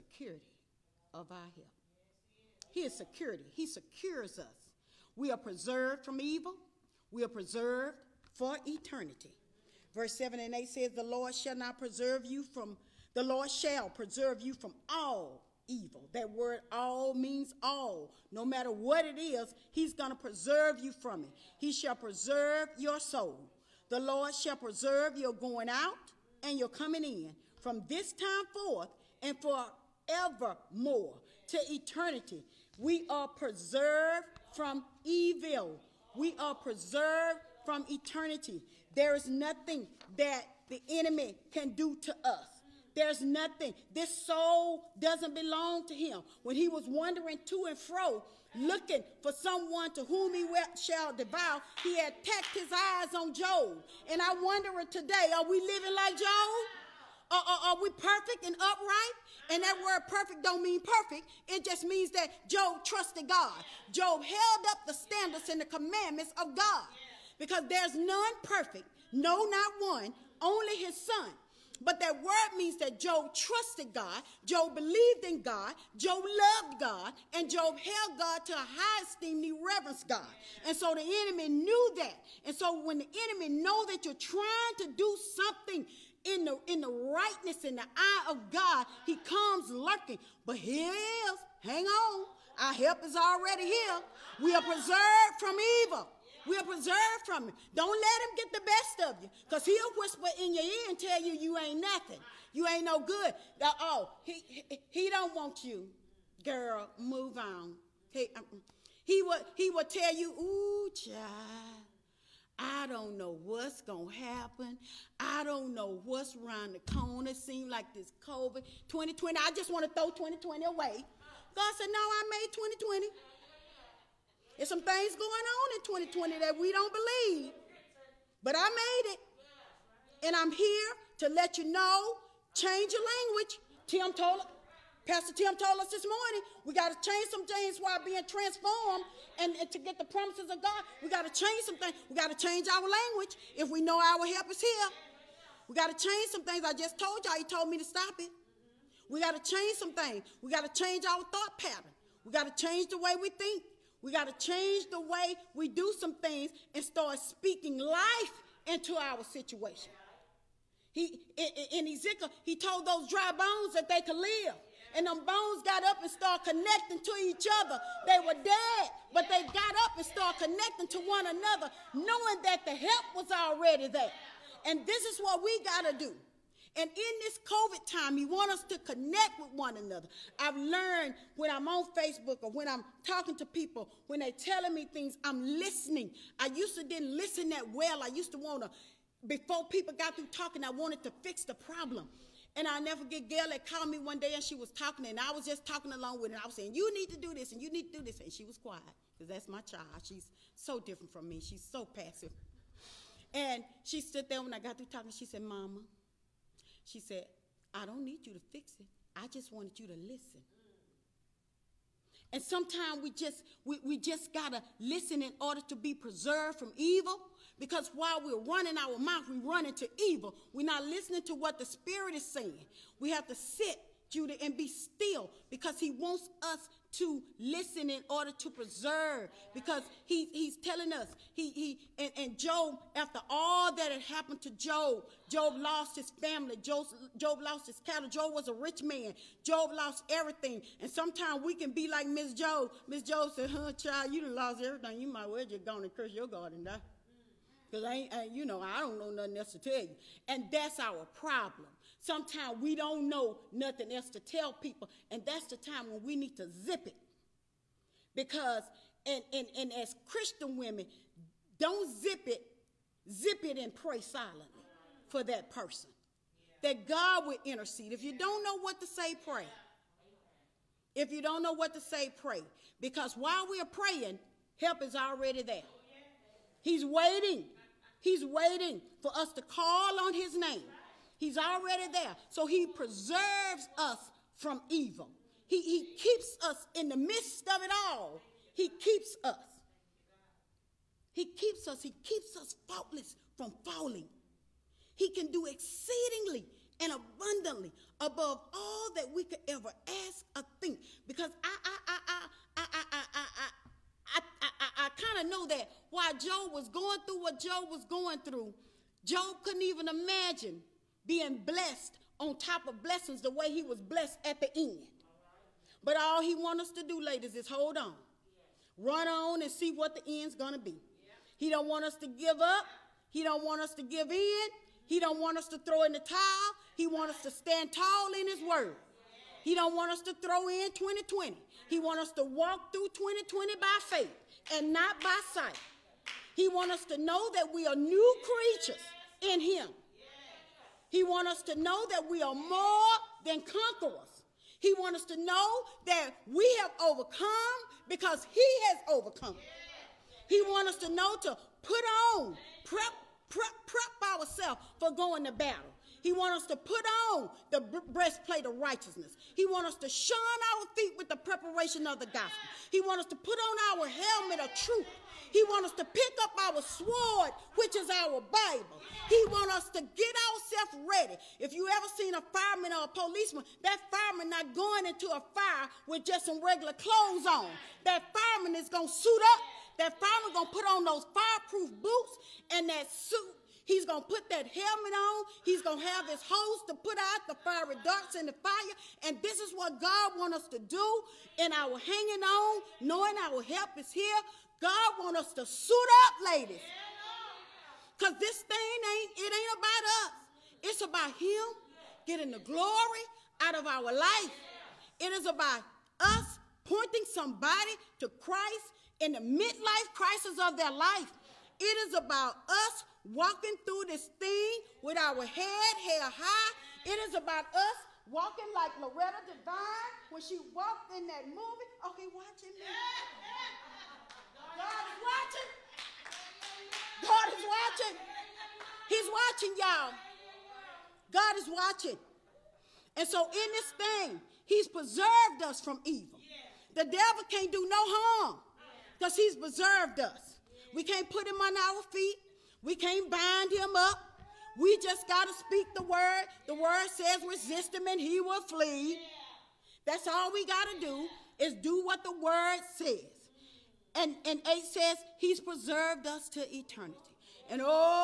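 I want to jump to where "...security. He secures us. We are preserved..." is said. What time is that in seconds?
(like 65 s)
2 s.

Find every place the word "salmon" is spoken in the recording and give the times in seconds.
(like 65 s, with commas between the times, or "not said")
not said.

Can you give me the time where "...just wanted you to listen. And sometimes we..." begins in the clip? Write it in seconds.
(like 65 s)
209 s.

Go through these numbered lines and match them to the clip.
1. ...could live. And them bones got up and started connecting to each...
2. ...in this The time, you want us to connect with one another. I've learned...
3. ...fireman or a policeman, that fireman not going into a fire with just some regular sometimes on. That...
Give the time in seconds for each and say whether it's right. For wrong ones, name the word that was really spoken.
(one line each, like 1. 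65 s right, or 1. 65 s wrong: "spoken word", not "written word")
1. 164 s right
2. 176 s wrong: "COVID", not "The"
3. 372 s wrong: "clothes", not "sometimes".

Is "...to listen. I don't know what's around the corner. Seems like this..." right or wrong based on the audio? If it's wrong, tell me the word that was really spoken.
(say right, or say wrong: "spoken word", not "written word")
wrong: "happen", not "listen".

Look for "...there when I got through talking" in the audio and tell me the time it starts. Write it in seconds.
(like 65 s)
204 s.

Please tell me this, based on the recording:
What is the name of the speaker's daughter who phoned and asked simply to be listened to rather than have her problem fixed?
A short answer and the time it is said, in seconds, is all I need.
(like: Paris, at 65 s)
Gail, at 193 s.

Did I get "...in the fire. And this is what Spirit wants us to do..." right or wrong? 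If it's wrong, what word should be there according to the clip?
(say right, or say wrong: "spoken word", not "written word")
wrong: "God", not "Spirit".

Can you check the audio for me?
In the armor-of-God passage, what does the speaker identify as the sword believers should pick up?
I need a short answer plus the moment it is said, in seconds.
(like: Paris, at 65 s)
Bible, at 368 s.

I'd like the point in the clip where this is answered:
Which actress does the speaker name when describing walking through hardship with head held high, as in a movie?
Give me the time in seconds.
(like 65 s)
418 s.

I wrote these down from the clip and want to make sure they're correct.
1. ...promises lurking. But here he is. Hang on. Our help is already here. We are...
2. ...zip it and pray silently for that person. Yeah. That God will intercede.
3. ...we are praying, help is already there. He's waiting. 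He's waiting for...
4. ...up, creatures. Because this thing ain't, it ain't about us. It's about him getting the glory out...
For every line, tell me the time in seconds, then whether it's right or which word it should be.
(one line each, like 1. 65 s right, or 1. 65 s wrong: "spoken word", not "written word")
1. 89 s wrong: "comes", not "promises"
2. 263 s right
3. 273 s right
4. 396 s wrong: "ladies", not "creatures".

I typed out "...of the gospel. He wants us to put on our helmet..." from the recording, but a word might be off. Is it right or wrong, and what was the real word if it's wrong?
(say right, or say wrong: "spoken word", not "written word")
right.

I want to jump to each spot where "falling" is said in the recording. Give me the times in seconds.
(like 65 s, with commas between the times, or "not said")
293 s.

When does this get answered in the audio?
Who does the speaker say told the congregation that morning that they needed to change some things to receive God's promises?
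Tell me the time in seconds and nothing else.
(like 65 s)
135 s.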